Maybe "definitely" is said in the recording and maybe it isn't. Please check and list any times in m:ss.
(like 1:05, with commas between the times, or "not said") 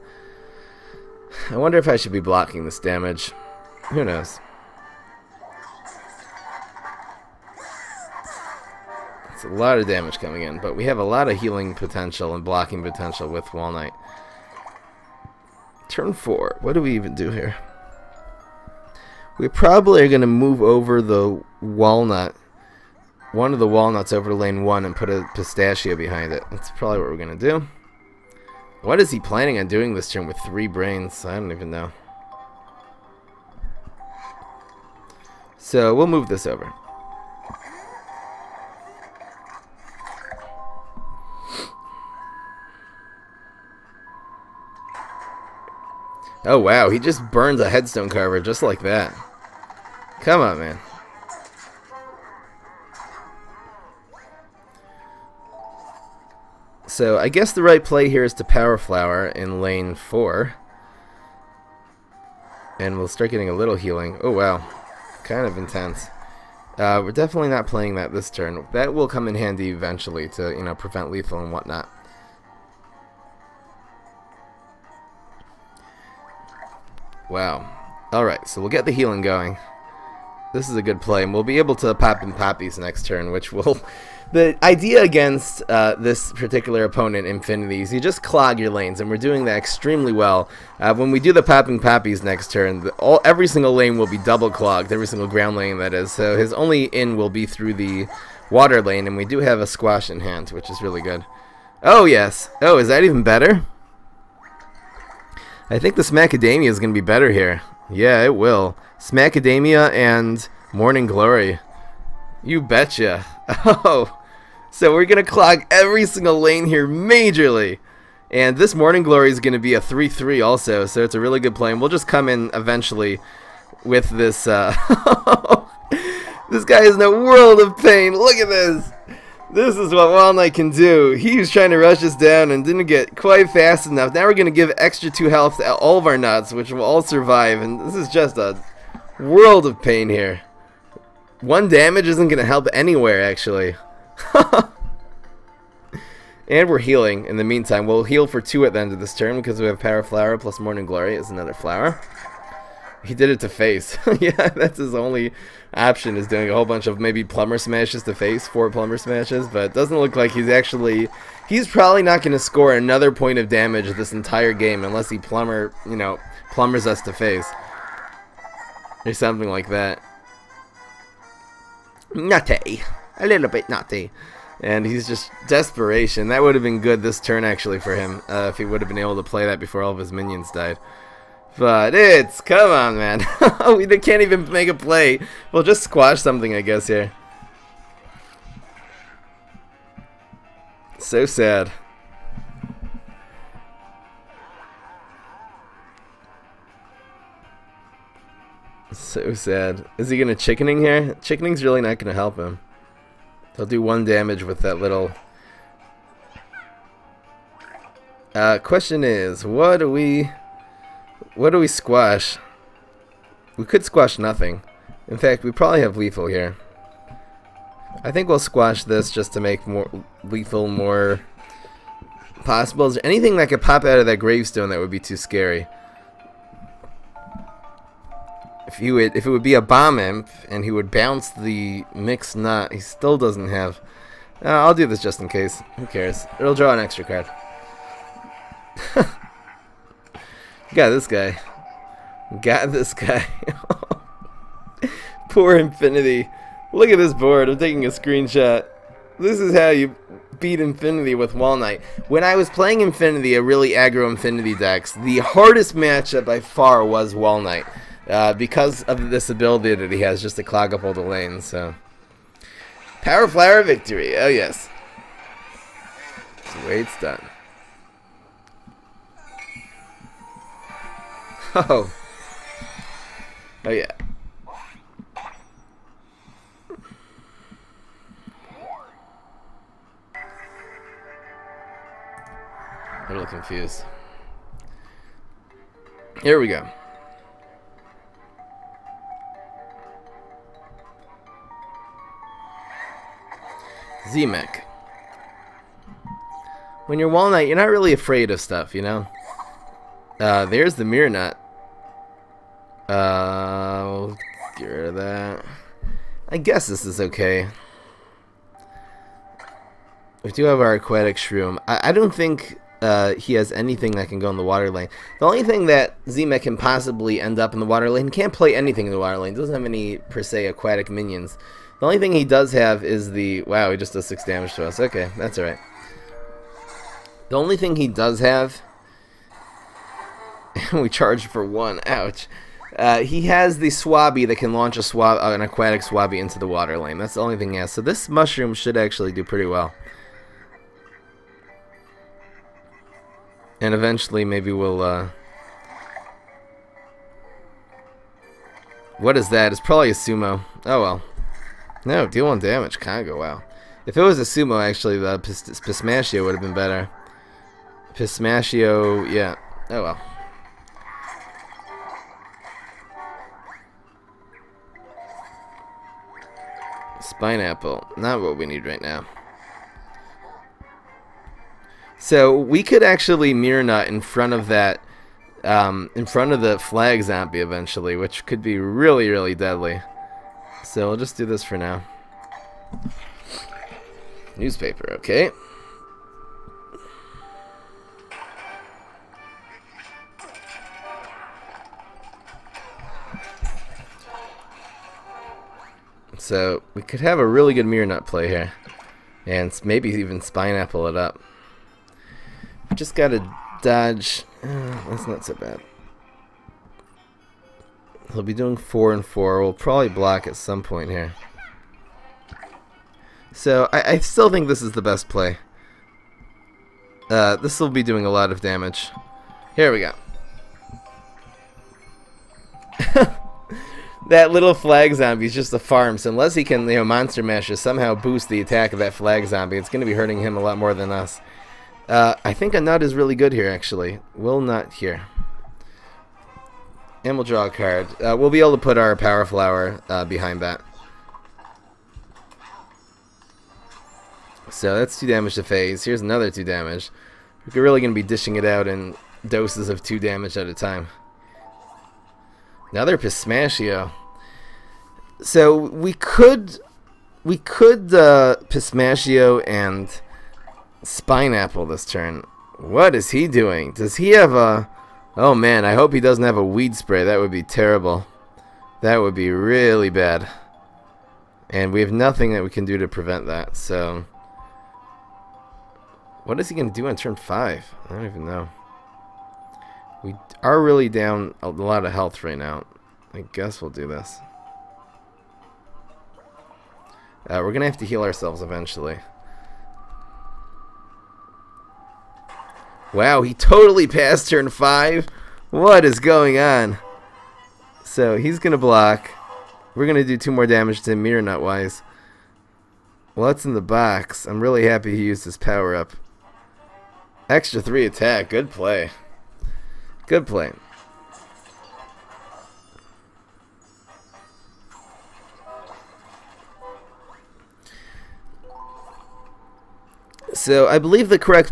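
1:07.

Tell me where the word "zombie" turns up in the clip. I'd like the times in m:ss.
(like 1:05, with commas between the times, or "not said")
6:17, 7:04, 7:09.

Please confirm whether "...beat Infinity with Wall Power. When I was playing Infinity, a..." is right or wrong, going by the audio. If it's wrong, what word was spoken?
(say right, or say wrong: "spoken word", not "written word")
wrong: "Knight", not "Power".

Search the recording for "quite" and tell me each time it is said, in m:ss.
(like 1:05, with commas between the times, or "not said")
2:13.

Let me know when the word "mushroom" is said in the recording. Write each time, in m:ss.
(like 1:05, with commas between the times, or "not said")
5:38.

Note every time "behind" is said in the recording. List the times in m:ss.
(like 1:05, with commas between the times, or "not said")
0:25, 7:20.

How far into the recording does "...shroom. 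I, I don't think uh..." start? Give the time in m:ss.
5:11.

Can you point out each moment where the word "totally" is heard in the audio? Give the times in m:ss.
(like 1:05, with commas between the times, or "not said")
8:13.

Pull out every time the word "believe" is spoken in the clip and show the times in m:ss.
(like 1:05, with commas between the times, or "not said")
8:40.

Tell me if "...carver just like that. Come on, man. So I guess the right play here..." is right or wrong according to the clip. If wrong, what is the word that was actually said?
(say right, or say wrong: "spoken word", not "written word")
right.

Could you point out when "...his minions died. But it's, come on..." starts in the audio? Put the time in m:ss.
2:59.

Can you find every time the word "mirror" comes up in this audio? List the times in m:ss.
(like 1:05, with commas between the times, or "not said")
5:00, 6:13, 6:37, 8:21.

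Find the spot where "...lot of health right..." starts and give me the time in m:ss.
8:01.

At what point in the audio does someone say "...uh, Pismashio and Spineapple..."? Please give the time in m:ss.
7:37.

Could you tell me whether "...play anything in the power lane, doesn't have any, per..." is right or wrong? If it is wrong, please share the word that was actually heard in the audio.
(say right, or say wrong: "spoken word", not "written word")
wrong: "water", not "power".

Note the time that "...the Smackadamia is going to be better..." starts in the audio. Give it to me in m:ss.
1:45.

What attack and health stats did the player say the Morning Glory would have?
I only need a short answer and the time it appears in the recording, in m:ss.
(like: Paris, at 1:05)
3-3, at 1:59.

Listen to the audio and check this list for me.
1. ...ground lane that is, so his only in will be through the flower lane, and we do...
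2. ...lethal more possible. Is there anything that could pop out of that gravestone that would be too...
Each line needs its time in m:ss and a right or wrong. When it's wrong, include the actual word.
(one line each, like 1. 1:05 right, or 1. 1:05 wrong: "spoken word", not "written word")
1. 1:35 wrong: "water", not "flower"
2. 3:40 right.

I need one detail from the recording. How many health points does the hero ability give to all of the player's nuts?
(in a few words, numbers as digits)
2.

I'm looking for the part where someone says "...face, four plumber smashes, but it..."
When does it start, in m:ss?
2:38.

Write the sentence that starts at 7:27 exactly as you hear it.
We're really going to be dishing it out in doses of two damage at a time.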